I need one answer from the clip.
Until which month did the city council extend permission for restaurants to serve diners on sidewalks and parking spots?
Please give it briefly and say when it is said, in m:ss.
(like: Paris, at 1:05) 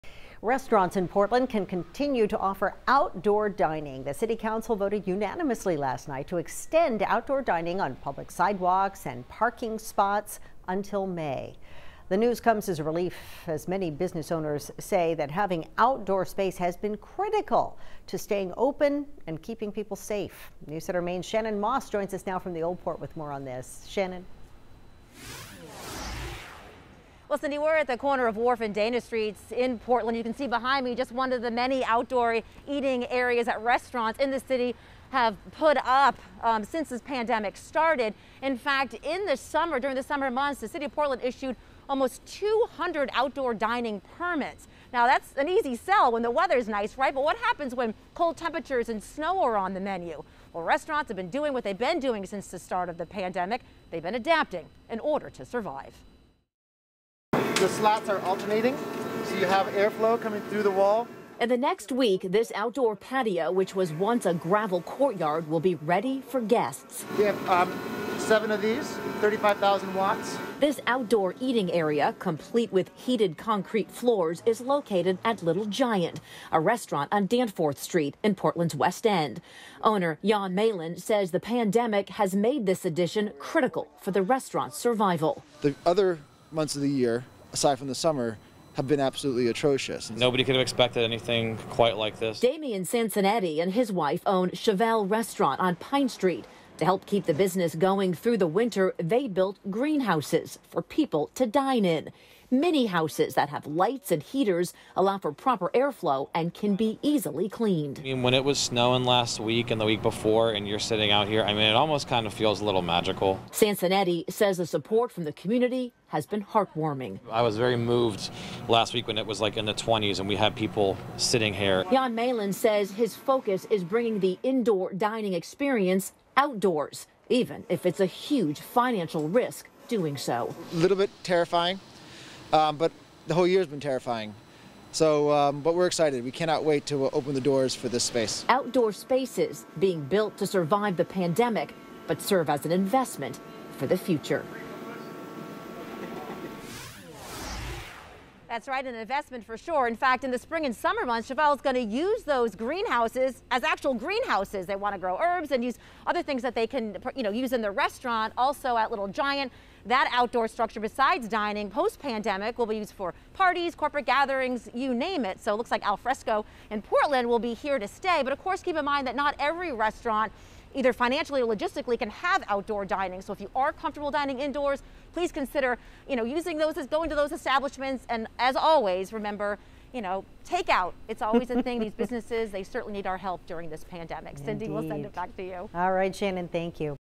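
May, at 0:11.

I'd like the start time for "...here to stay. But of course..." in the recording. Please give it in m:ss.
2:47.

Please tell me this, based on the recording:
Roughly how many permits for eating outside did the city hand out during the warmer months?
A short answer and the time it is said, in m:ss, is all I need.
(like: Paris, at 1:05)
200, at 0:41.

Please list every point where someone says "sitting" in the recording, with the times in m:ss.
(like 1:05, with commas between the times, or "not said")
1:50, 2:01.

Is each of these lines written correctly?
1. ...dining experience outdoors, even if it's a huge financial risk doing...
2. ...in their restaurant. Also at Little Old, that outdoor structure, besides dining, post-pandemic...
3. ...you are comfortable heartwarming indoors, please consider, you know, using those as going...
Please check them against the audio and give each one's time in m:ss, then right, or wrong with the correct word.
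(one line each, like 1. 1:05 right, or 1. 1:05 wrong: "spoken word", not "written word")
1. 2:04 right
2. 2:37 wrong: "Giant", not "Old"
3. 2:53 wrong: "dining", not "heartwarming".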